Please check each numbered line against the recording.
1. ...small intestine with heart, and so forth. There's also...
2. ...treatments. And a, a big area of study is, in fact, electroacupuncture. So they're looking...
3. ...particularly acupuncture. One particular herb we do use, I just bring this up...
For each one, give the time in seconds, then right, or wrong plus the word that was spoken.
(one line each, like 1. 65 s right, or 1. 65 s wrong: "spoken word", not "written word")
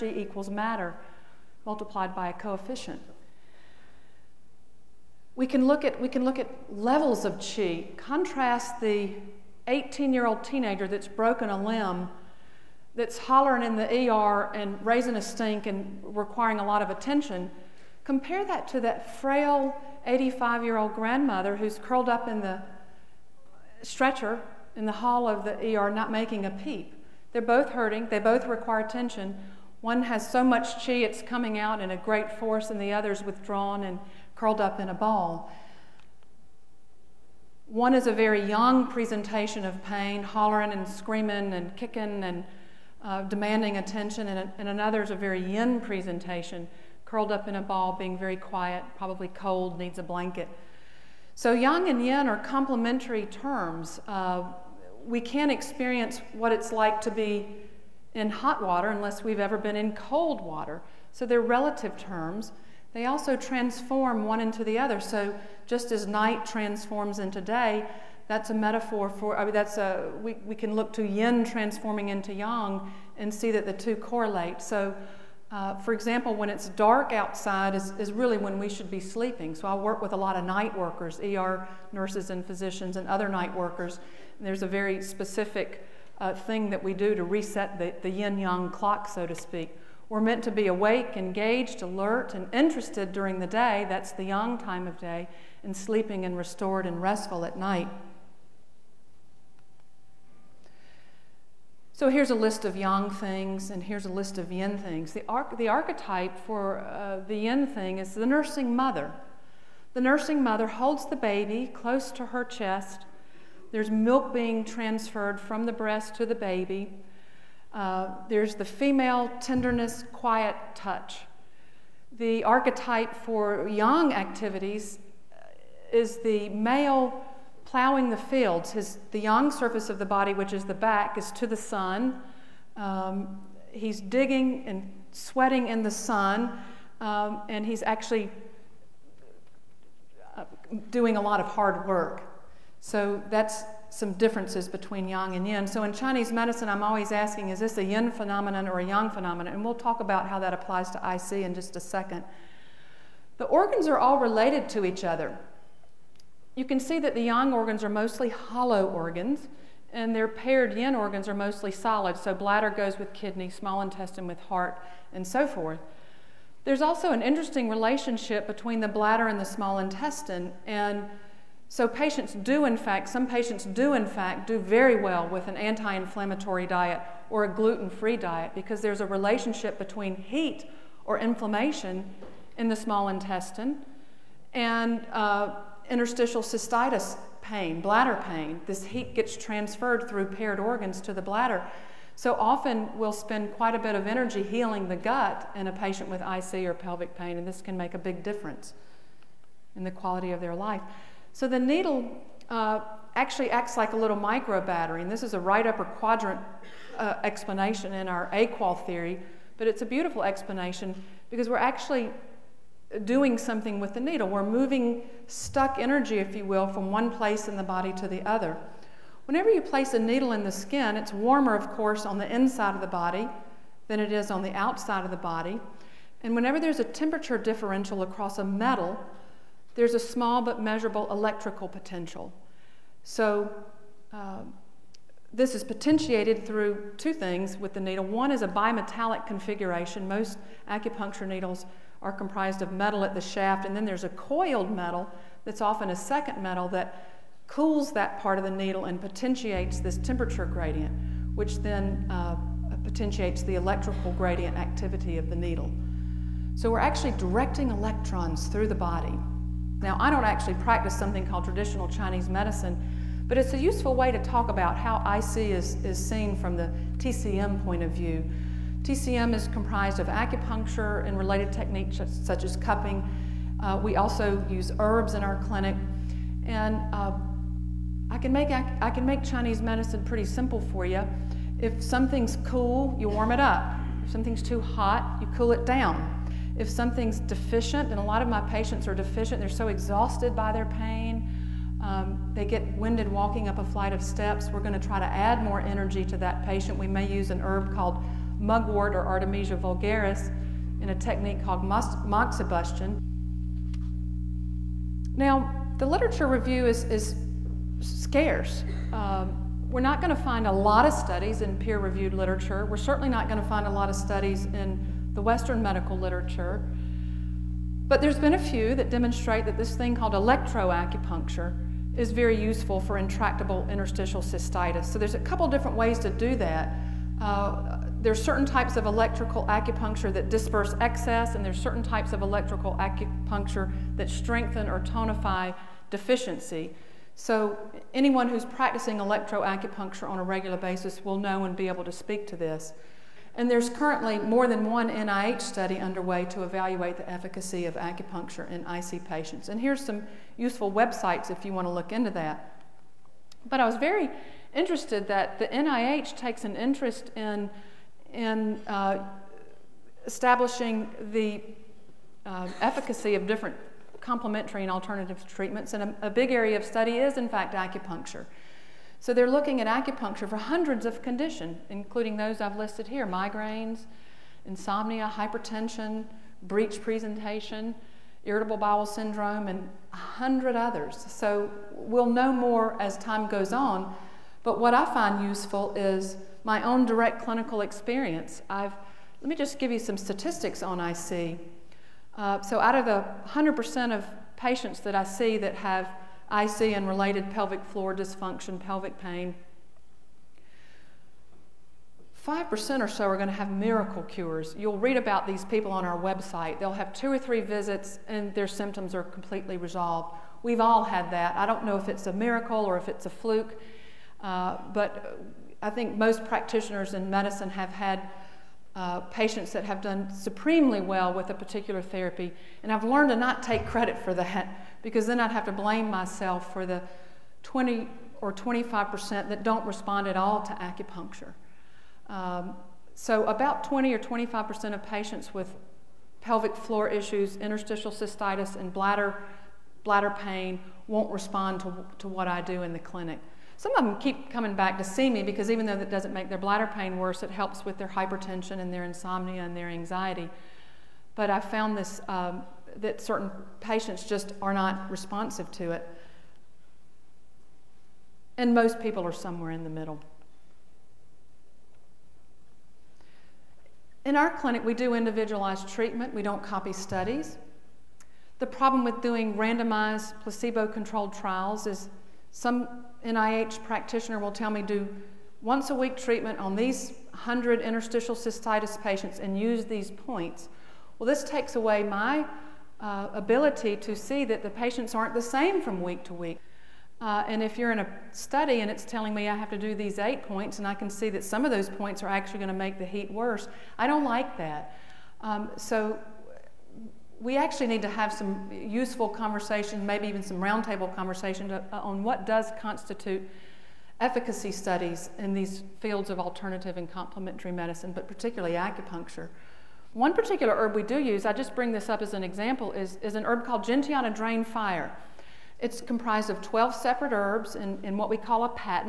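1. 163 s right
2. 365 s wrong: "acupuncture", not "electroacupuncture"
3. 508 s right.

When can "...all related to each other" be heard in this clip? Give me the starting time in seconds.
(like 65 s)
153 s.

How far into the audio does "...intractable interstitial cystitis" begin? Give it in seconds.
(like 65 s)
322 s.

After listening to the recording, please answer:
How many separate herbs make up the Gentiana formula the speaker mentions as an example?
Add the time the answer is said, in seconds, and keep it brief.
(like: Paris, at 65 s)
12, at 516 s.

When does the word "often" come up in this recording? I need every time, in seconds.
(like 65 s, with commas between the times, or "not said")
192 s, 245 s.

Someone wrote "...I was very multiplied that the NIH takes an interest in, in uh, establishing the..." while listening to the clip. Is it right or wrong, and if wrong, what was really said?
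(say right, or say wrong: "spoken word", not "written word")
wrong: "interested", not "multiplied".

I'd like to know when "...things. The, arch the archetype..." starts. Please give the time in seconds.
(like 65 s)
104 s.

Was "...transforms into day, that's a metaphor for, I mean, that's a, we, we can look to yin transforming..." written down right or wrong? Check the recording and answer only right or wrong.
right.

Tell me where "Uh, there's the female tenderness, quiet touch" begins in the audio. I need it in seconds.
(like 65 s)
117 s.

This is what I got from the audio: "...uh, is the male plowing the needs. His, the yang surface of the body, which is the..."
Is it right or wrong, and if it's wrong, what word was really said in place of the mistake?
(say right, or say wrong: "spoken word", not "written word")
wrong: "fields", not "needs".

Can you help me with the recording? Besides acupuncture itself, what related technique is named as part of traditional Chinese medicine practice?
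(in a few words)
cupping.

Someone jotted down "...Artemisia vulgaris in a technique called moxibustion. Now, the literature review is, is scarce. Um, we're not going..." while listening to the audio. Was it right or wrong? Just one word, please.
right.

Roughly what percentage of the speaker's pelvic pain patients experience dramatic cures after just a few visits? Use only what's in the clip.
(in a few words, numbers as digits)
5%.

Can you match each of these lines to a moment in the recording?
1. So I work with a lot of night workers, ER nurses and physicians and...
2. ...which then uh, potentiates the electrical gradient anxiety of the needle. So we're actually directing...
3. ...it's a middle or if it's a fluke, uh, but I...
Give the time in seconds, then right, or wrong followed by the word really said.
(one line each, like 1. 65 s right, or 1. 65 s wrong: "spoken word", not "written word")
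1. 79 s right
2. 251 s wrong: "activity", not "anxiety"
3. 411 s wrong: "miracle", not "middle".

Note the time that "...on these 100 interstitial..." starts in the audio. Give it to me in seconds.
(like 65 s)
476 s.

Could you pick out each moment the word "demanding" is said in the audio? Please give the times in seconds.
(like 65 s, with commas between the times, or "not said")
43 s.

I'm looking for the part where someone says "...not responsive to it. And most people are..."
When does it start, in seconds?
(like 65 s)
454 s.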